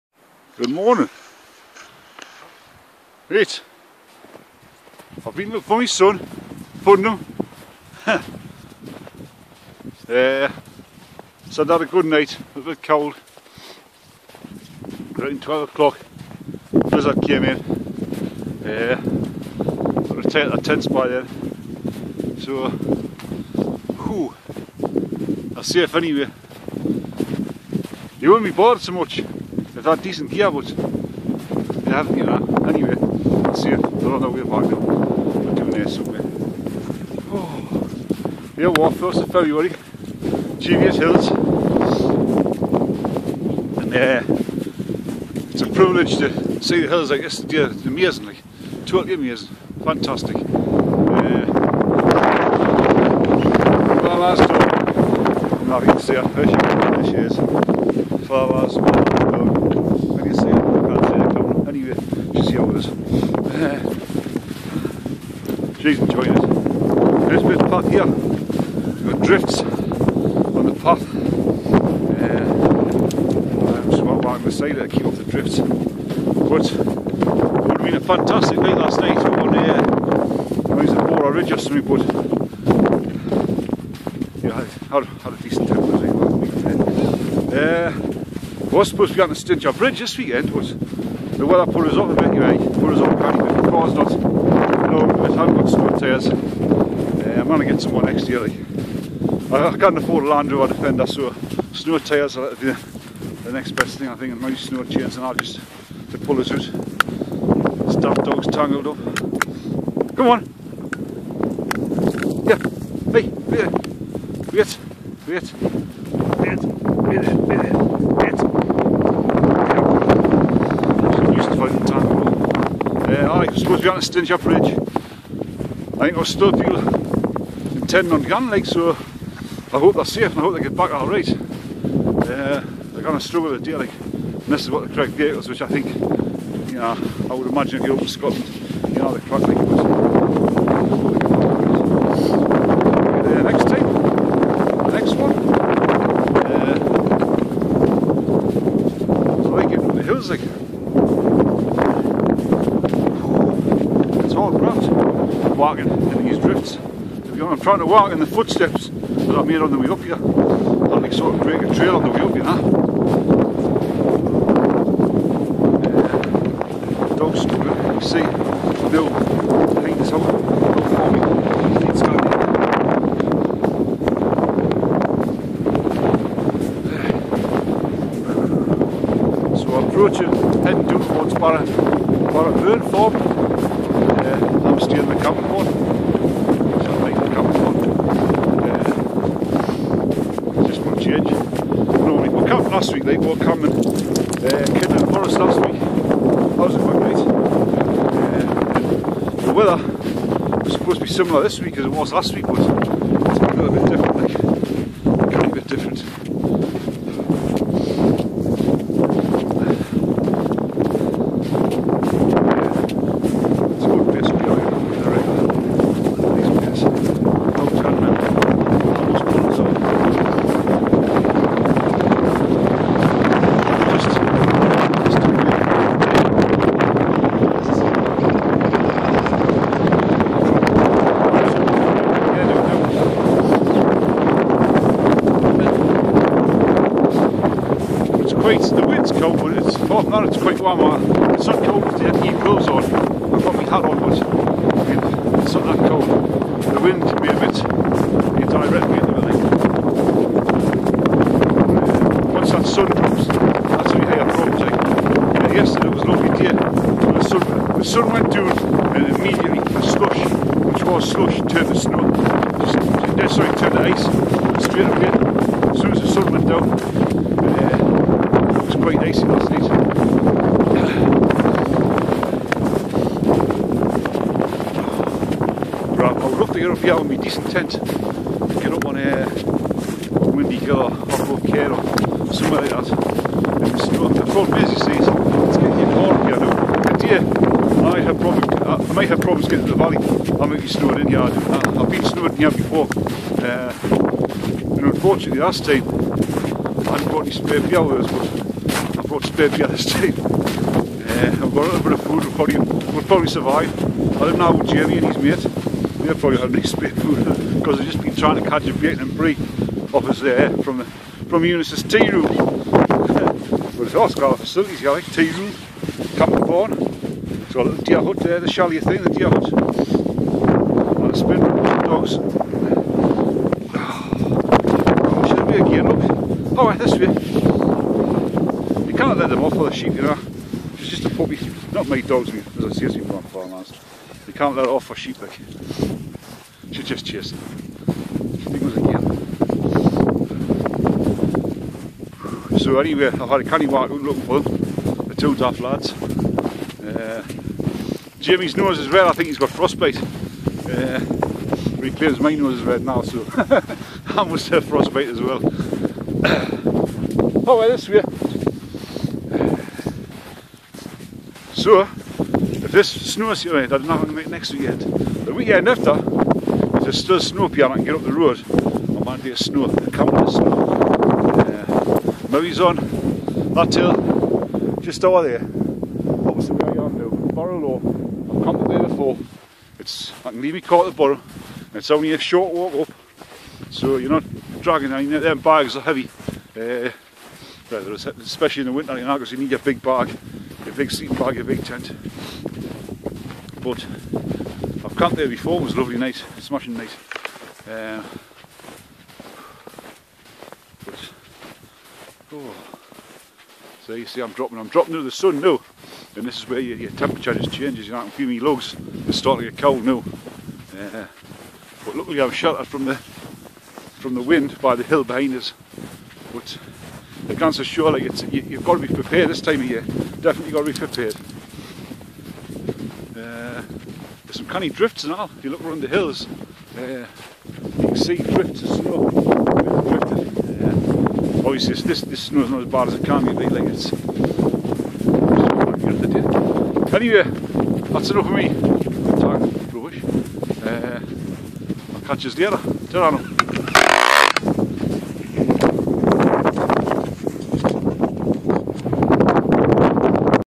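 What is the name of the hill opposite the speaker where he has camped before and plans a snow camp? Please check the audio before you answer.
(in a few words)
Barrow Law.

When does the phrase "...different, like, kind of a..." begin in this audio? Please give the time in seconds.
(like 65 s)
203 s.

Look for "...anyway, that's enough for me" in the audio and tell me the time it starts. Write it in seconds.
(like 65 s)
437 s.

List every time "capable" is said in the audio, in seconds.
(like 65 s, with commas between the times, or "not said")
not said.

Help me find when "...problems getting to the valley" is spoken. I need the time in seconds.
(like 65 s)
289 s.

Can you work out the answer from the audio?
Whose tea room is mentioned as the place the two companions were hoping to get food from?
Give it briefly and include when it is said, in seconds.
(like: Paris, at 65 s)
Eunice's, at 311 s.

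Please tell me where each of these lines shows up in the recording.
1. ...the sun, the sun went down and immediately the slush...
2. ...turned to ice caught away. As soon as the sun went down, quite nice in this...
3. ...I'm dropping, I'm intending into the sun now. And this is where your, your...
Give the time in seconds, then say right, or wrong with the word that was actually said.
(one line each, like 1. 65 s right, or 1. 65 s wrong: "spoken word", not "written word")
1. 256 s right
2. 263 s wrong: "straight", not "caught"
3. 404 s wrong: "dropping", not "intending".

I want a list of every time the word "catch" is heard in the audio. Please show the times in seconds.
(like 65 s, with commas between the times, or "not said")
308 s, 442 s.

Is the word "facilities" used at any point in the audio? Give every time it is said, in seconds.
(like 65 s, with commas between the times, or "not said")
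314 s.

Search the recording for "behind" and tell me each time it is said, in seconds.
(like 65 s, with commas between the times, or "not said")
169 s, 415 s.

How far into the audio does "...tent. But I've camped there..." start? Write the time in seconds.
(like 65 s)
391 s.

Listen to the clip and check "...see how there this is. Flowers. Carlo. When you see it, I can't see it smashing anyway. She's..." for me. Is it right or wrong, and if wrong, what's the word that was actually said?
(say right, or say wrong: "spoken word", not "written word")
wrong: "coming", not "smashing".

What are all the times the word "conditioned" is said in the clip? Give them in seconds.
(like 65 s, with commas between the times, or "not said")
not said.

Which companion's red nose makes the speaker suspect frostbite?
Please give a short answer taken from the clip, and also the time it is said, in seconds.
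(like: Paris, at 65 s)
Jamie, at 348 s.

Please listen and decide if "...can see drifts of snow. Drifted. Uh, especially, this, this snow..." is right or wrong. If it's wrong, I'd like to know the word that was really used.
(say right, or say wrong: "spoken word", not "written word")
wrong: "obviously", not "especially".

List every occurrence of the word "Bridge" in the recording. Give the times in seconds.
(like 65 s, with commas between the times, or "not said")
89 s, 124 s.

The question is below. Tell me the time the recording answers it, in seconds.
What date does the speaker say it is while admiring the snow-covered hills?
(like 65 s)
38 s.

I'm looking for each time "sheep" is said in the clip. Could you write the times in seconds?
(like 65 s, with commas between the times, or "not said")
329 s, 334 s.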